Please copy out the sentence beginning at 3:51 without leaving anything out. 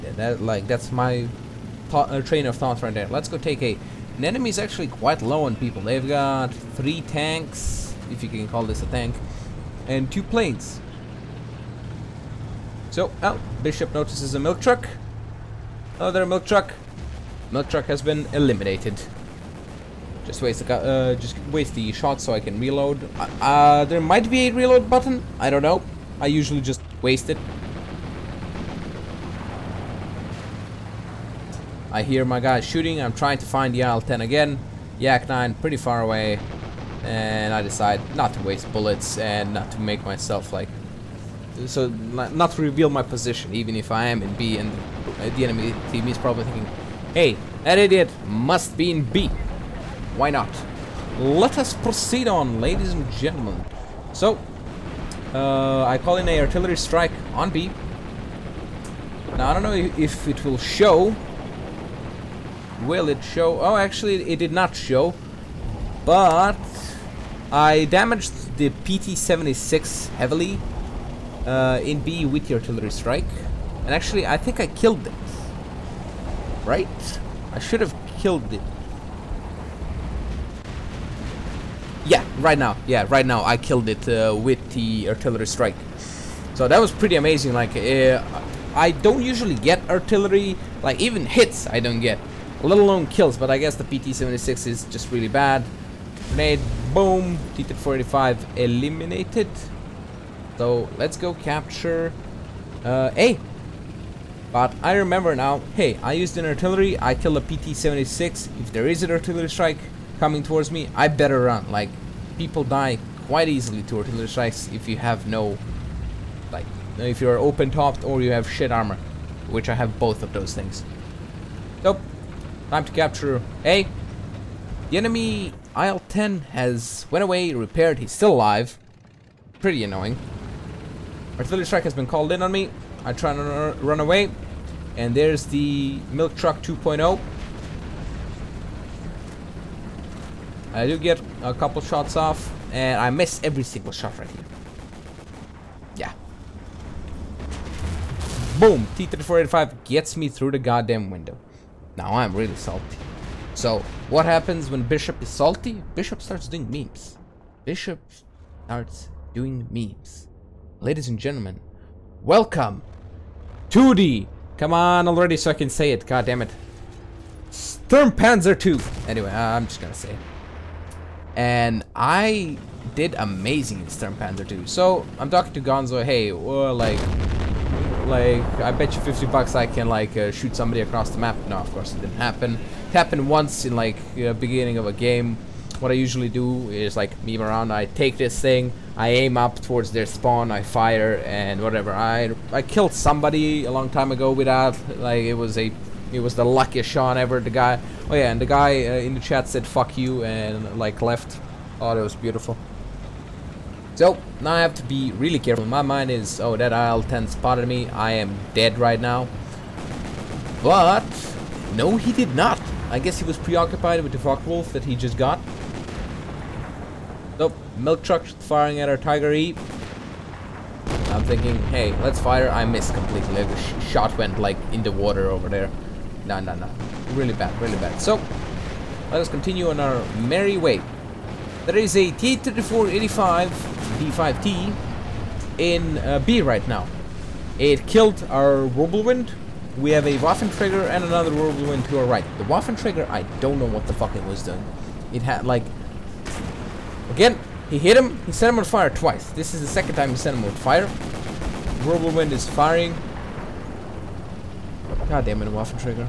There is a T-3485 D5T in uh, B right now.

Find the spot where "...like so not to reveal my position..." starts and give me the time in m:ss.
0:40.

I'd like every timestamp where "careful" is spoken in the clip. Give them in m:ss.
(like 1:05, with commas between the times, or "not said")
3:25.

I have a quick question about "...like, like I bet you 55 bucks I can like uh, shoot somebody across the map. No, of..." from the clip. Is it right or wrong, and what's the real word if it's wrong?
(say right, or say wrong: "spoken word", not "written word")
wrong: "50", not "55".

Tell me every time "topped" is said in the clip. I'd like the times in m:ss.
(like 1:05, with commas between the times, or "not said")
1:57.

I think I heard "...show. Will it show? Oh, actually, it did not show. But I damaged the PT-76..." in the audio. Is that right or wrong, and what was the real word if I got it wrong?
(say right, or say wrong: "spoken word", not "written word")
right.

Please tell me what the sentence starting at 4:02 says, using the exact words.
The Waffenträger, I don't know what the fuck it was doing.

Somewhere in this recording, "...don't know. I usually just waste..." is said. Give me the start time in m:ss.
0:25.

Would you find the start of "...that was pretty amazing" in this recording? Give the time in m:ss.
1:26.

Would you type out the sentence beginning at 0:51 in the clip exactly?
Let us proceed on, ladies and gentlemen.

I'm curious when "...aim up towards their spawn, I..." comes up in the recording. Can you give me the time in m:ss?
3:09.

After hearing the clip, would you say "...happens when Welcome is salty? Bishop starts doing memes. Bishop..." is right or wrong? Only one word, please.
wrong.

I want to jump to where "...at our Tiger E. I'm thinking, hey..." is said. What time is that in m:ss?
3:38.